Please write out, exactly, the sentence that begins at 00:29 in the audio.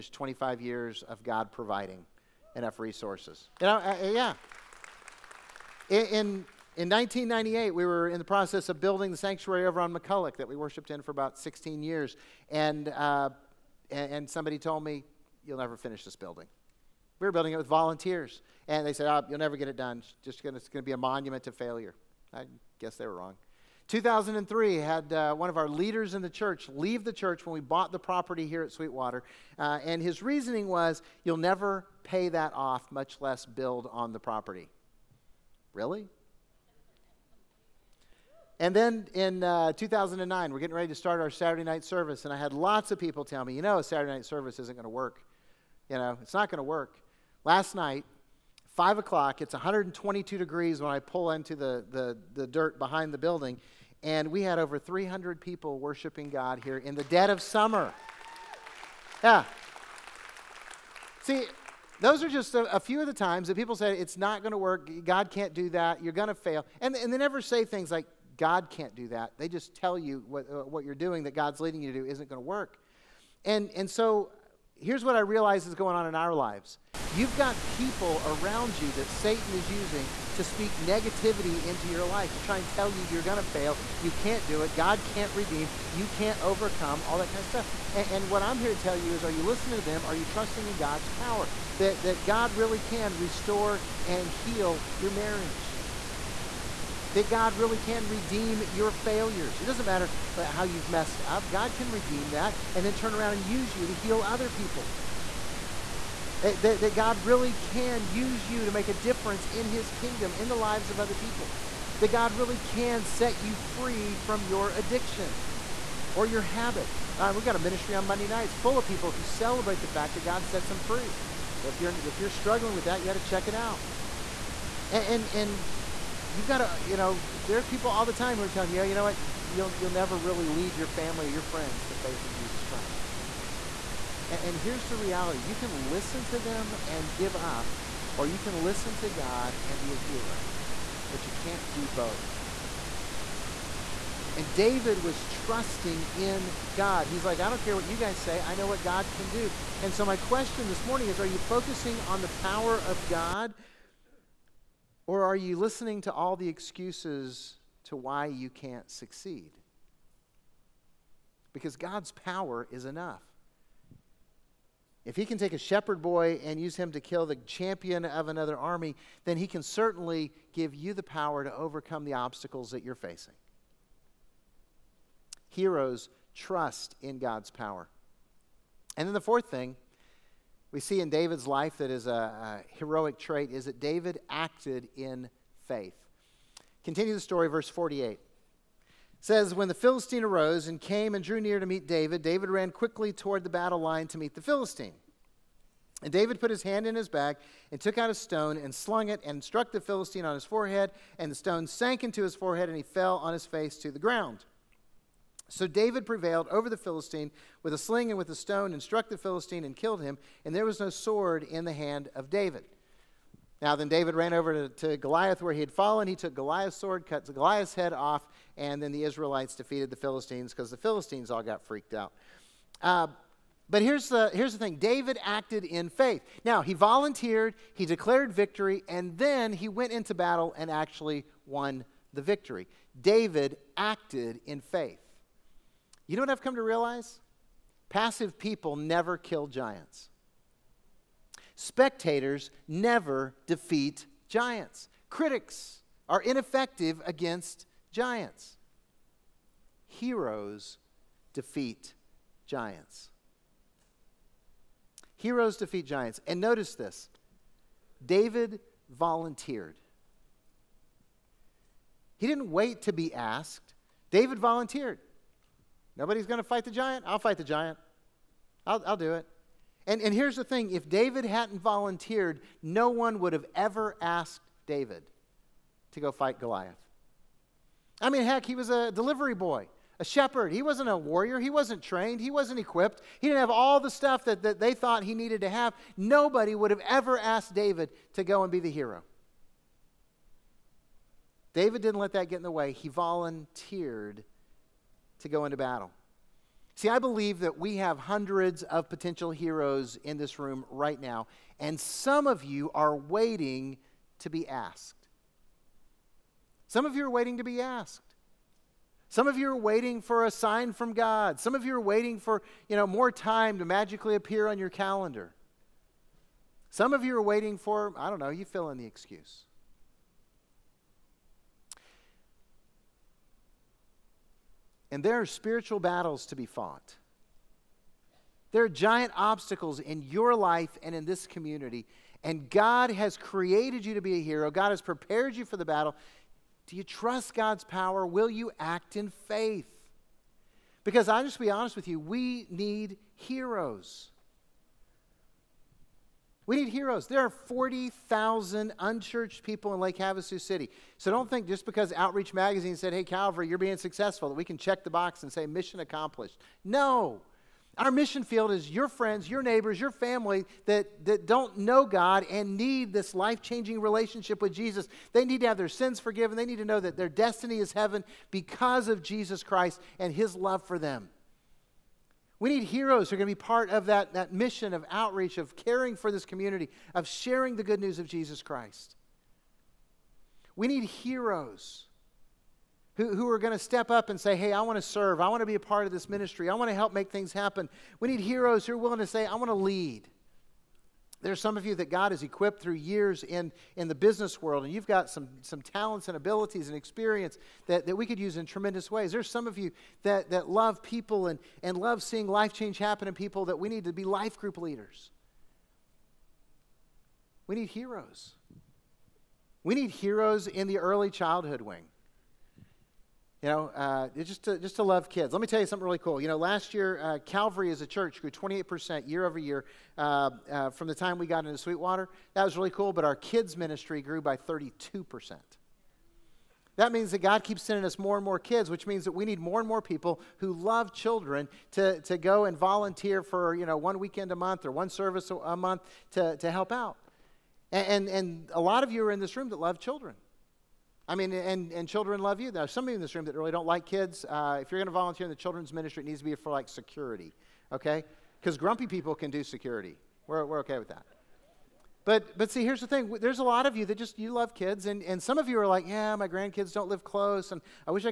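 Uh, and his reasoning was, you'll never pay that off, much less build on the property.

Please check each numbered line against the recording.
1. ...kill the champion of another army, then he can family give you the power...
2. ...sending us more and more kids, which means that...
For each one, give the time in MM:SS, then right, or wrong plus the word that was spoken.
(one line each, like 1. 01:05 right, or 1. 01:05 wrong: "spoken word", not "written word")
1. 02:46 wrong: "certainly", not "family"
2. 07:07 right.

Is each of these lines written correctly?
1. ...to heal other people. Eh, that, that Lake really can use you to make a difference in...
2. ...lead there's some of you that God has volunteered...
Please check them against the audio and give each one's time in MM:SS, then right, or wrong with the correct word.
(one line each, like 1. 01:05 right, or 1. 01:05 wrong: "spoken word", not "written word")
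1. 01:43 wrong: "God", not "Lake"
2. 06:29 wrong: "equipped", not "volunteered".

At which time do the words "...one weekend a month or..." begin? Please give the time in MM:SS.
07:13.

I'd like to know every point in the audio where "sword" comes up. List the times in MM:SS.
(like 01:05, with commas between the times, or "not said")
03:30, 03:36.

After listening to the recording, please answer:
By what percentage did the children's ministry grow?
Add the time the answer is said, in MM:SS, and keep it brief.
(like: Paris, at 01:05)
32%, at 07:04.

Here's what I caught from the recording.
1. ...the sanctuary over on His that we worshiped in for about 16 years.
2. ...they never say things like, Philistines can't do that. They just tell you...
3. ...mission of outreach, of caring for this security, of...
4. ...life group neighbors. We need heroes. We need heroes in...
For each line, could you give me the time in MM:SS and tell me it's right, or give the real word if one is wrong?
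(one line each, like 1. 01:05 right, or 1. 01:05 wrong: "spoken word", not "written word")
1. 00:09 wrong: "McCulloch", not "His"
2. 01:07 wrong: "God", not "Philistines"
3. 06:14 wrong: "community", not "security"
4. 06:44 wrong: "leaders", not "neighbors".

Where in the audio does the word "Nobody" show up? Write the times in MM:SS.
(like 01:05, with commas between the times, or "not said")
04:25, 04:45.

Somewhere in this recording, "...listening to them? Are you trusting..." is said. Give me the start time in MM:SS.
01:29.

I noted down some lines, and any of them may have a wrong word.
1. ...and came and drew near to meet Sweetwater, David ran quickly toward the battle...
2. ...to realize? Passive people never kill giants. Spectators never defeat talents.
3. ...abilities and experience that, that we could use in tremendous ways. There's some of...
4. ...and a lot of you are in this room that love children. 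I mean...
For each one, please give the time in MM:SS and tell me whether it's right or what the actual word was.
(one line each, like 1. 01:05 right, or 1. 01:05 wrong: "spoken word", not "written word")
1. 03:10 wrong: "David", not "Sweetwater"
2. 03:56 wrong: "giants", not "talents"
3. 06:36 right
4. 07:18 right.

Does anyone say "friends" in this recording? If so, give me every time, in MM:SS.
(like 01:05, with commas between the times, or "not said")
02:11, 05:58.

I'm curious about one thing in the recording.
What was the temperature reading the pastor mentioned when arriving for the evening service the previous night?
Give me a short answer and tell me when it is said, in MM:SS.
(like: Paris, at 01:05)
122 degrees, at 00:49.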